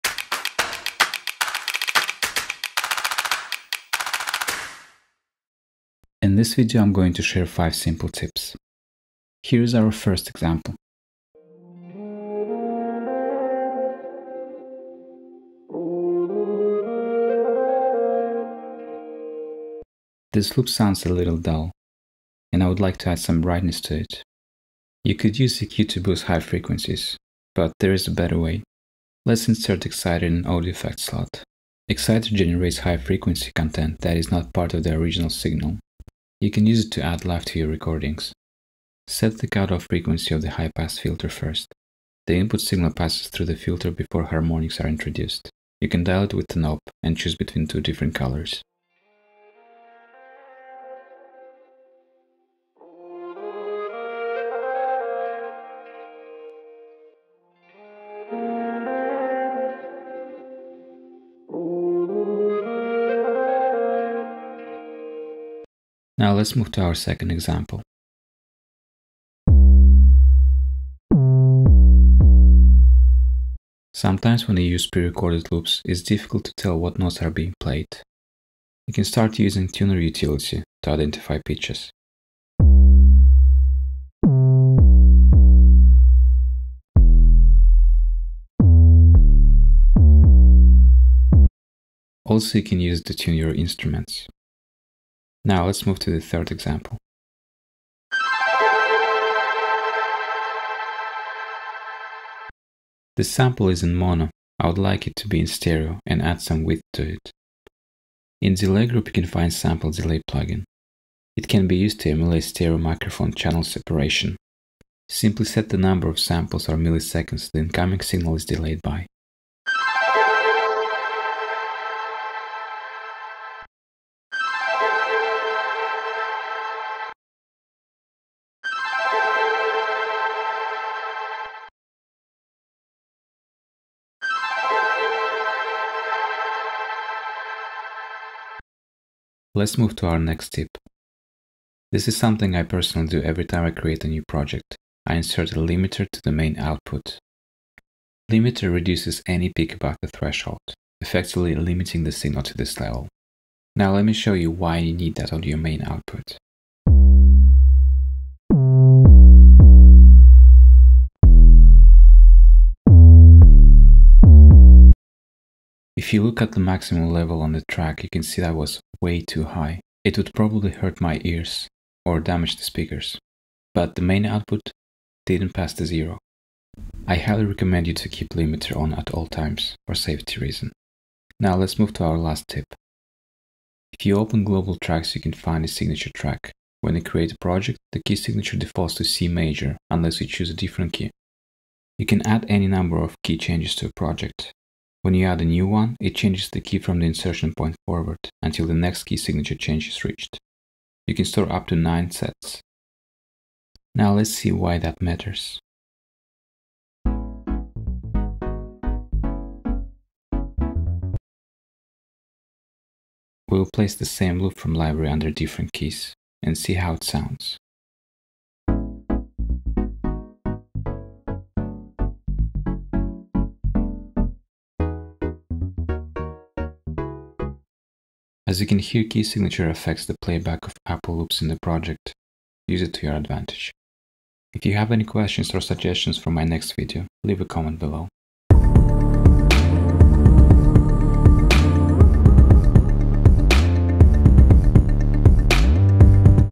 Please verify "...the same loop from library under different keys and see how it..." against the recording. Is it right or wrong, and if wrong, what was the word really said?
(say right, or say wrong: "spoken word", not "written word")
right.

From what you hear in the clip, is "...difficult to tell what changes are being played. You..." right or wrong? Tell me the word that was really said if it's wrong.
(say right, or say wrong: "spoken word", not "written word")
wrong: "notes", not "changes".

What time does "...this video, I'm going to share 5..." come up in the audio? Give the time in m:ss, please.
0:06.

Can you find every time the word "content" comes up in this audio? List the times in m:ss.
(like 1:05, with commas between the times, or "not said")
0:33.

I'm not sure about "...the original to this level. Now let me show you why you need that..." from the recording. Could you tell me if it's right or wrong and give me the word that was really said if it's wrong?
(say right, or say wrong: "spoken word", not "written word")
wrong: "signal", not "original".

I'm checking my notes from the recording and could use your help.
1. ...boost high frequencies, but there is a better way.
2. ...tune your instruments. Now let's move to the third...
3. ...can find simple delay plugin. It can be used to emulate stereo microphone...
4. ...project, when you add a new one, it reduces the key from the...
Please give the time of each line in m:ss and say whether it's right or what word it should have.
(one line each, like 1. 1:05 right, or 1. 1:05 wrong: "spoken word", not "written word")
1. 0:26 right
2. 1:33 right
3. 1:49 wrong: "sample", not "simple"
4. 3:13 wrong: "changes", not "reduces".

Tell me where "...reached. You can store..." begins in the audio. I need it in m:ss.
3:20.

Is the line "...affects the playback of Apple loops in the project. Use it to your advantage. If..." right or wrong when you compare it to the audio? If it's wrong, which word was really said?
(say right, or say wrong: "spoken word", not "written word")
right.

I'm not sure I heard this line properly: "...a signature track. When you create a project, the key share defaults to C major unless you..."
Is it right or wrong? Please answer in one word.
wrong.